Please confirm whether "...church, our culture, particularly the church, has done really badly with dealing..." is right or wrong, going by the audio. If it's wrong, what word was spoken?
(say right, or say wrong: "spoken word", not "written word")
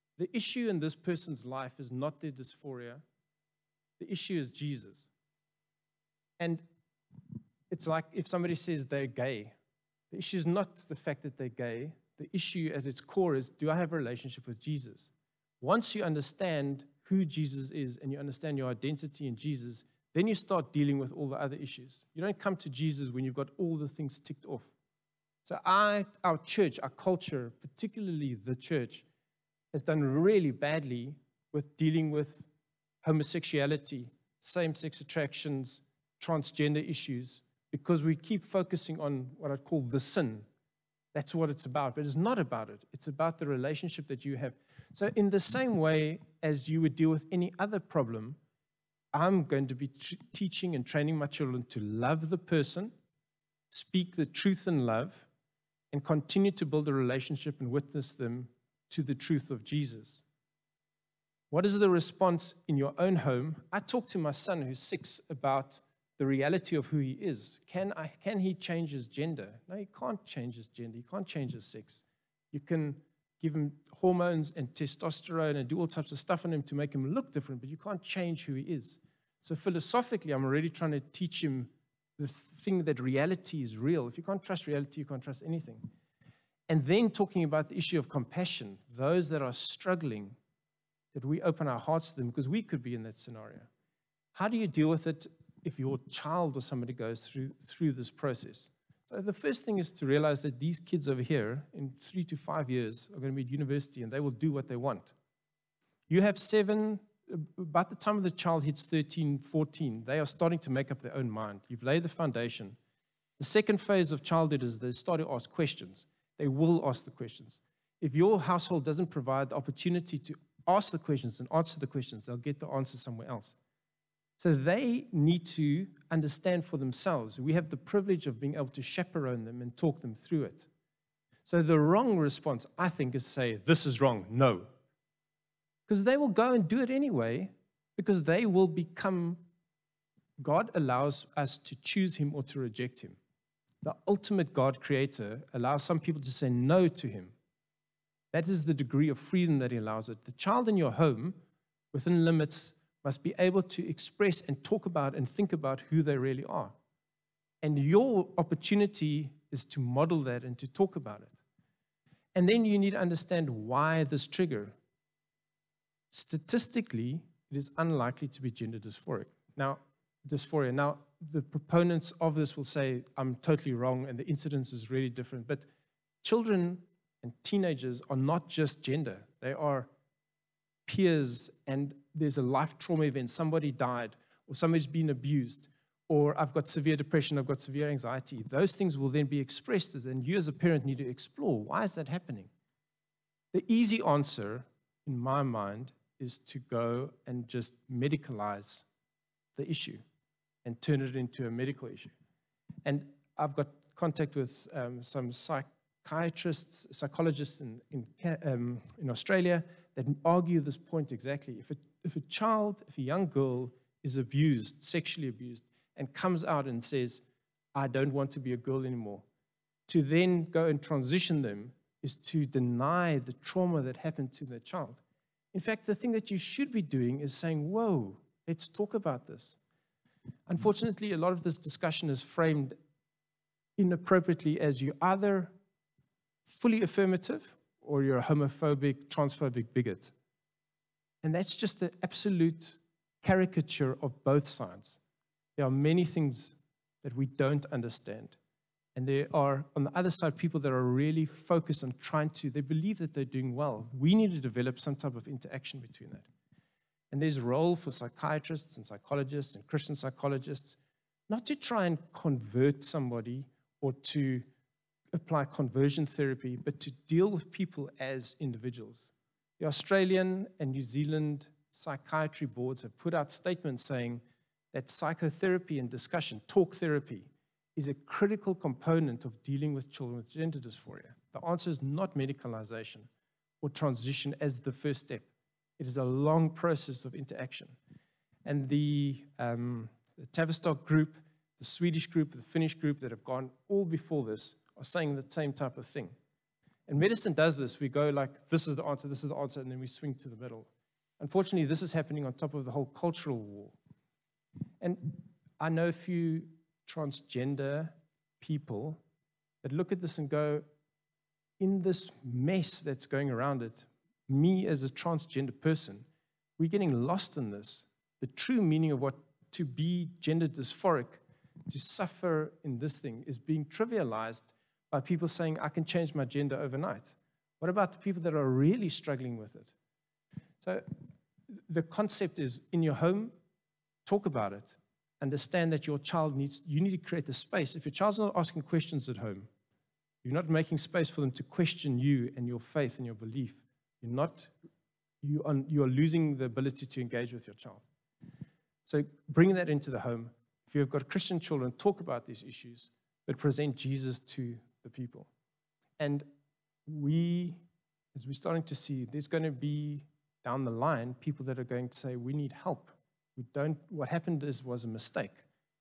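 right.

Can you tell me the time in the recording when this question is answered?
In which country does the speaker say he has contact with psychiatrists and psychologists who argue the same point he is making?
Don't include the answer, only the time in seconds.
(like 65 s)
209 s.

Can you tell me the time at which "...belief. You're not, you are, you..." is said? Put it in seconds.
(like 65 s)
343 s.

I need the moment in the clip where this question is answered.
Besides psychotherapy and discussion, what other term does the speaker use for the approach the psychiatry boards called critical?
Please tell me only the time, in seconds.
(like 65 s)
276 s.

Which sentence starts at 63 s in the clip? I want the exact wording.
I talk to my son who's six about the reality of who he is.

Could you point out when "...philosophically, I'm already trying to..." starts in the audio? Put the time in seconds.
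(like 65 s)
79 s.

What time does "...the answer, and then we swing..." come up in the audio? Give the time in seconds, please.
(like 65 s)
299 s.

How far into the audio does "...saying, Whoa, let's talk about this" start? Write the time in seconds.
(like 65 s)
227 s.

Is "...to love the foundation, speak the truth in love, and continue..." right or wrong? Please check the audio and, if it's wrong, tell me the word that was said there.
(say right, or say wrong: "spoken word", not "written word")
wrong: "person", not "foundation".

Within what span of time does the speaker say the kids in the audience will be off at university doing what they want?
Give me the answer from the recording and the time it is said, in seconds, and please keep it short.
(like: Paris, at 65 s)
3 to 5 years, at 102 s.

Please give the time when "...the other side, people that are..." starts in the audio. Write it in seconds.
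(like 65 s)
249 s.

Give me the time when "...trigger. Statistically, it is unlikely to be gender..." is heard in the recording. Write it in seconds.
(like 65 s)
164 s.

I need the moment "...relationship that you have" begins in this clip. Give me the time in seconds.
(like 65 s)
43 s.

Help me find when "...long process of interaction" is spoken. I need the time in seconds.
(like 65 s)
286 s.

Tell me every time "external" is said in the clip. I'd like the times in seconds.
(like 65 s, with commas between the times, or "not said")
not said.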